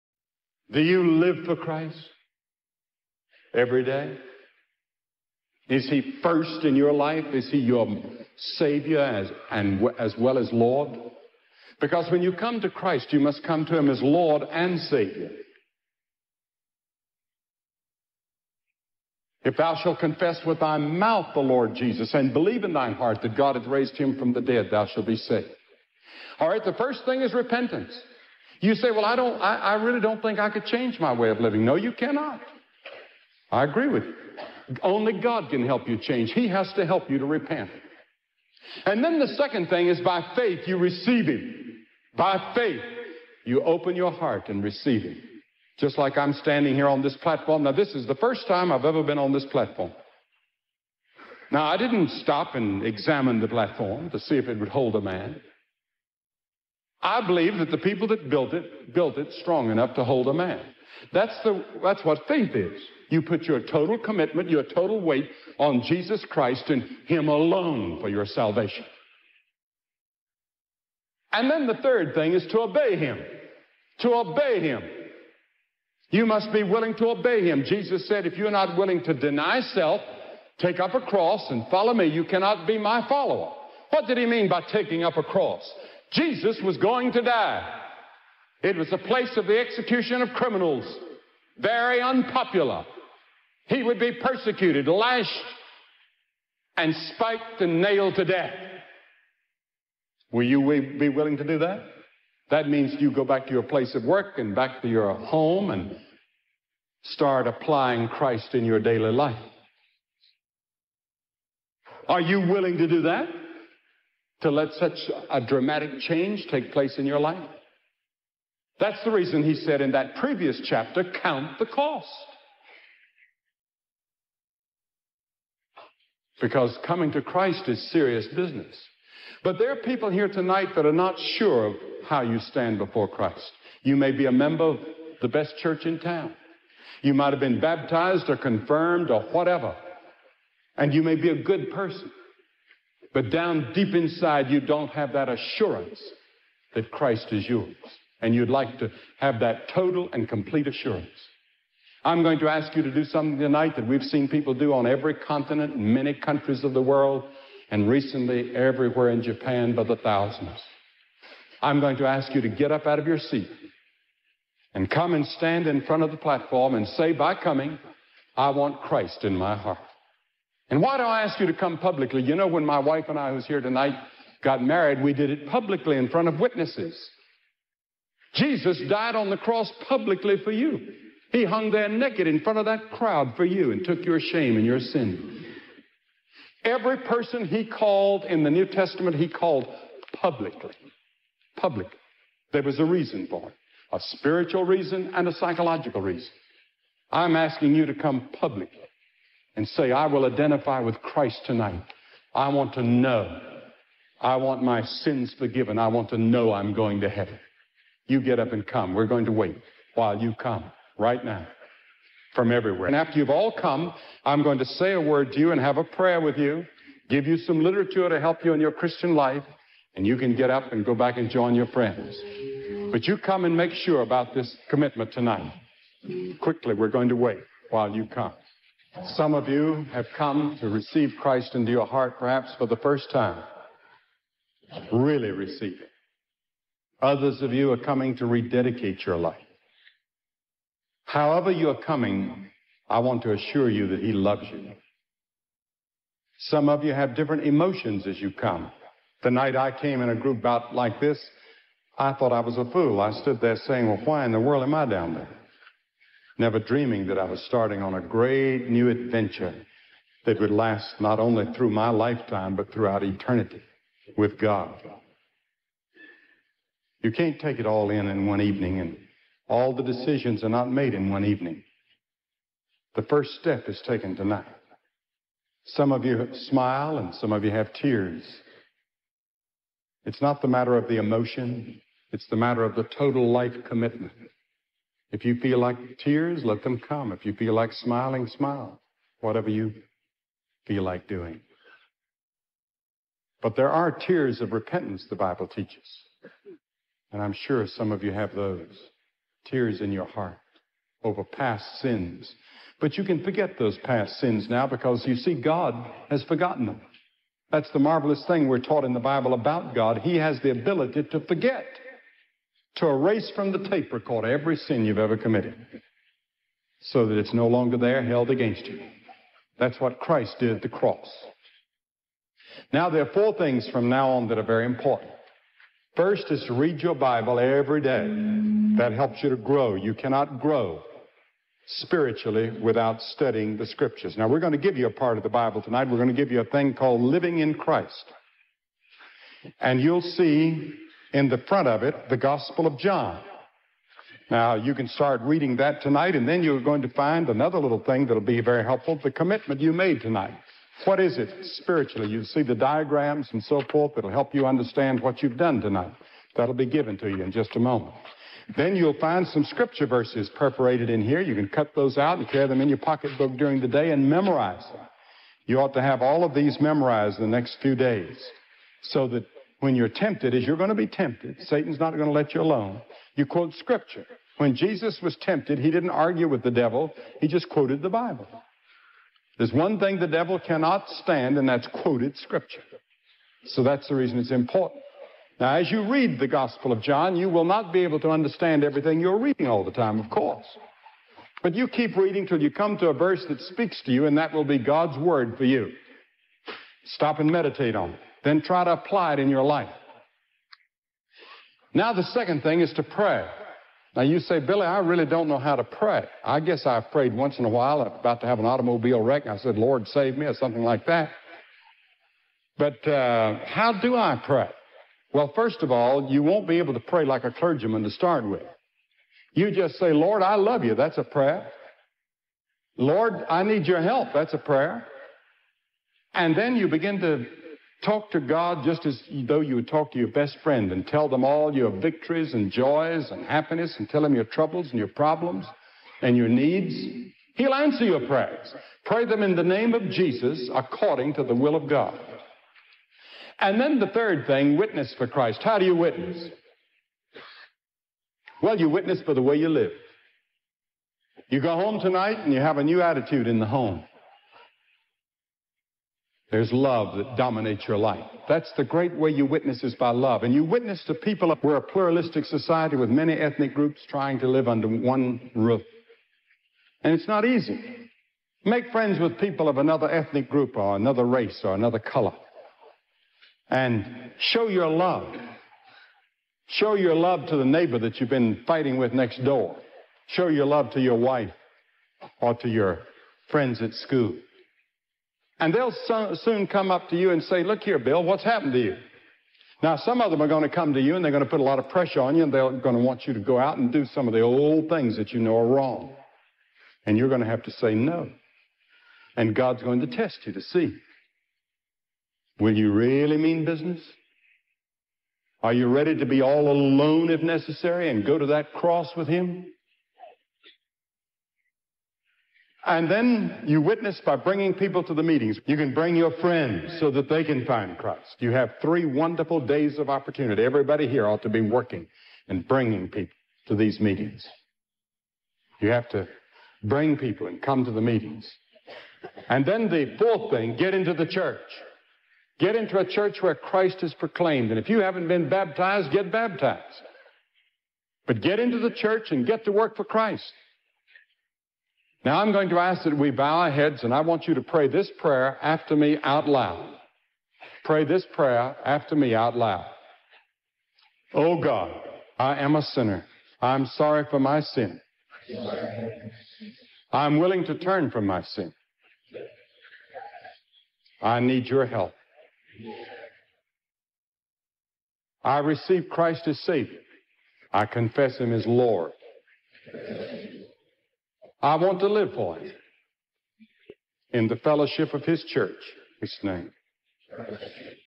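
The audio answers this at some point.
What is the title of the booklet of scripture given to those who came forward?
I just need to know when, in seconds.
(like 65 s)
337 s.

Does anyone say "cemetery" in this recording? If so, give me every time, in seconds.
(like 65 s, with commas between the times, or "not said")
not said.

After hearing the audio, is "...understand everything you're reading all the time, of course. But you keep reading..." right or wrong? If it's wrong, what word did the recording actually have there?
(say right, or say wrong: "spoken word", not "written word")
right.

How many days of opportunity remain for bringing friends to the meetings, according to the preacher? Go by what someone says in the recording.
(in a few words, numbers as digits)
3.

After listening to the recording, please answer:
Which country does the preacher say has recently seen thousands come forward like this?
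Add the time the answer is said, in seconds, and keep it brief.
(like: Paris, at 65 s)
Japan, at 159 s.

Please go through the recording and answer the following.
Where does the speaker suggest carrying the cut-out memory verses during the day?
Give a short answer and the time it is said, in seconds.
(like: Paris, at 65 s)
pocketbook, at 362 s.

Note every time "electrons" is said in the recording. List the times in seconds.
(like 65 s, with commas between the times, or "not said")
not said.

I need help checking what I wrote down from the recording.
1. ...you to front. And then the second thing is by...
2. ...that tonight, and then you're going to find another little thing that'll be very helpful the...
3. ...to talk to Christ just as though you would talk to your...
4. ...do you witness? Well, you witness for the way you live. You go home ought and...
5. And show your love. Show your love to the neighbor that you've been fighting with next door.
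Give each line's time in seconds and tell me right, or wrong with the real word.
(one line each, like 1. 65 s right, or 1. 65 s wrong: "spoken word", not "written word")
1. 37 s wrong: "repent", not "front"
2. 345 s right
3. 427 s wrong: "God", not "Christ"
4. 445 s wrong: "tonight", not "ought"
5. 473 s right.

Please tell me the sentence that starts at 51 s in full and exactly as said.
Now, I didn't stop and examine the platform to see if it would hold a man.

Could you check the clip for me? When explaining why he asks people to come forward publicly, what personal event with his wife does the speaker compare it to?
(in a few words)
got married.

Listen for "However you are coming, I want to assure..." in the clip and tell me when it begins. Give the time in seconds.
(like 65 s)
241 s.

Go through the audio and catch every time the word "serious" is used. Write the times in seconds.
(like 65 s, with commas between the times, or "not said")
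127 s.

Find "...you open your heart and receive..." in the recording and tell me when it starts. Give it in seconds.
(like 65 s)
43 s.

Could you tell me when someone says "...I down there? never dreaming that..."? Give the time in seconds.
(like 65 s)
254 s.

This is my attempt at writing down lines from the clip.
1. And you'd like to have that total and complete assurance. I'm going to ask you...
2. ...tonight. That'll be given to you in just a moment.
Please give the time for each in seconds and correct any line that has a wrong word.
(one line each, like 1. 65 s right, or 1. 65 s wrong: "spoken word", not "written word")
1. 148 s right
2. 355 s right.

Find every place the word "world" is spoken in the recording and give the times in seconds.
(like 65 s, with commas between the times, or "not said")
156 s, 254 s.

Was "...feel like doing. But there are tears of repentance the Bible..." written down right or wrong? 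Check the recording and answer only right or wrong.
right.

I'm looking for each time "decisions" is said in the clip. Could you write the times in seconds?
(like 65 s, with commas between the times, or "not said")
269 s.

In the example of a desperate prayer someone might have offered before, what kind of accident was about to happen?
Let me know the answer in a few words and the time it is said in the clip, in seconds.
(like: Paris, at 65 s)
automobile wreck, at 408 s.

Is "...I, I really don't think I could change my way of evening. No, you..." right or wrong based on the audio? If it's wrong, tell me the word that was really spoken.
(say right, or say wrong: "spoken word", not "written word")
wrong: "living", not "evening".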